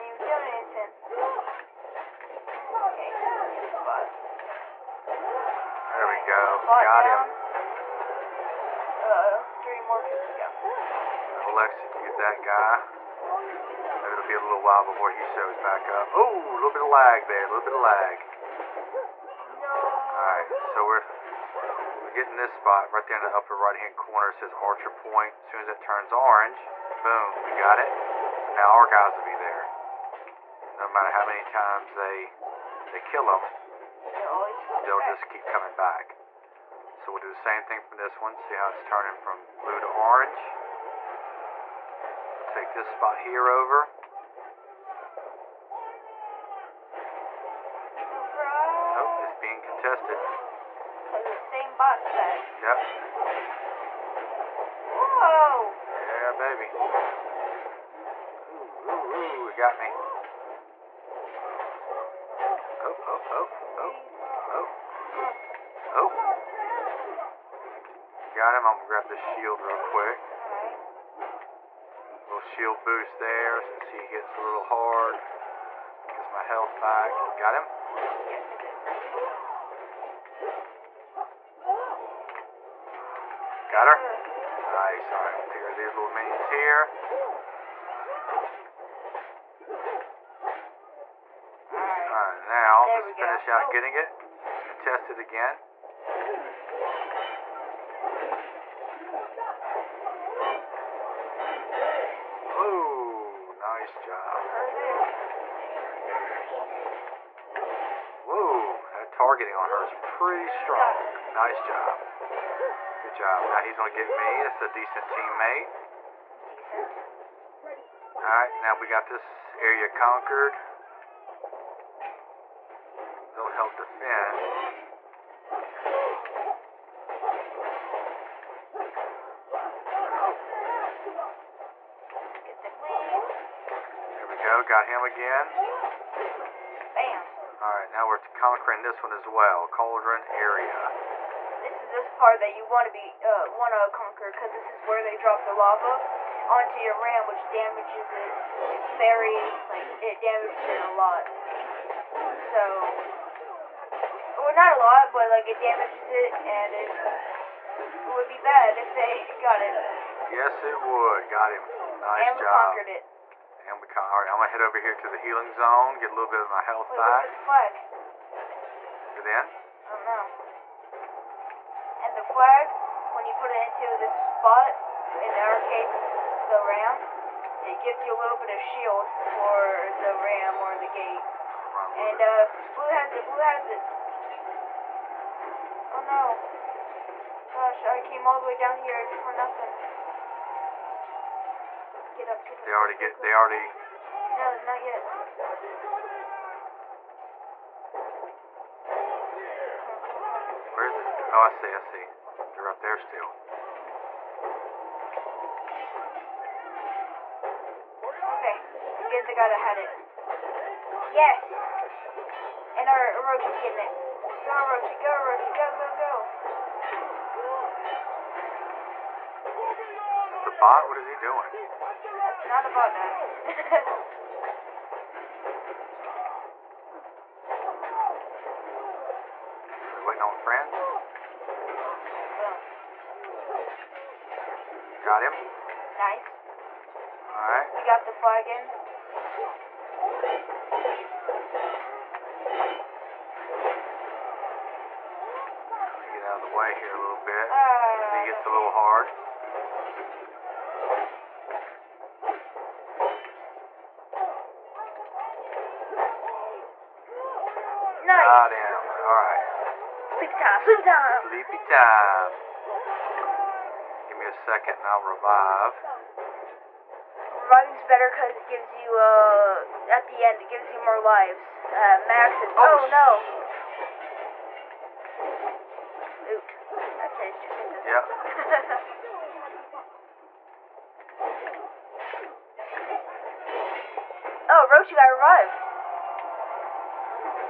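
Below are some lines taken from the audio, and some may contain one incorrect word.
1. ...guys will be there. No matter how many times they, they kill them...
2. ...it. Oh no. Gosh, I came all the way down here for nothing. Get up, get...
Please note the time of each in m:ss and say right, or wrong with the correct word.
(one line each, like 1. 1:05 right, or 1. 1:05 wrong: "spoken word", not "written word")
1. 0:28 right
2. 3:03 right.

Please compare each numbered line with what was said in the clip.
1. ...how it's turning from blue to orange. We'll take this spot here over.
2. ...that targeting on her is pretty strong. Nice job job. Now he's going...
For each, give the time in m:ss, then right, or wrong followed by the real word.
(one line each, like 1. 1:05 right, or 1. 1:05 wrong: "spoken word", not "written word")
1. 0:38 right
2. 1:48 right.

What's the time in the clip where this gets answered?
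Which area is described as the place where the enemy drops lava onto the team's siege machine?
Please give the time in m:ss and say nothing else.
2:19.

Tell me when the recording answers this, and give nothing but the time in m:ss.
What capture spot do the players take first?
0:24.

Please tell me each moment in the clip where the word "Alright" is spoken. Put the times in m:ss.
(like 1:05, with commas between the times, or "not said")
0:20, 1:31, 1:58, 2:17, 3:57, 4:19.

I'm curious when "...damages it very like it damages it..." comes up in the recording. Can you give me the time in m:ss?
2:27.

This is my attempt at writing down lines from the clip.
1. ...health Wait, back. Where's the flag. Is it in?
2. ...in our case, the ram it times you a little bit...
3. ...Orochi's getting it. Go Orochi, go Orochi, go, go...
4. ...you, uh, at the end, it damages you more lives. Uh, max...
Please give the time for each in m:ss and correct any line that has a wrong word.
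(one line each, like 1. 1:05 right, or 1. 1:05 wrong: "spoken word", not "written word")
1. 2:46 right
2. 2:55 wrong: "gives", not "times"
3. 3:33 right
4. 4:28 wrong: "gives", not "damages".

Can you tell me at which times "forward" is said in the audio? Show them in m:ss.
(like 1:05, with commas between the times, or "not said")
not said.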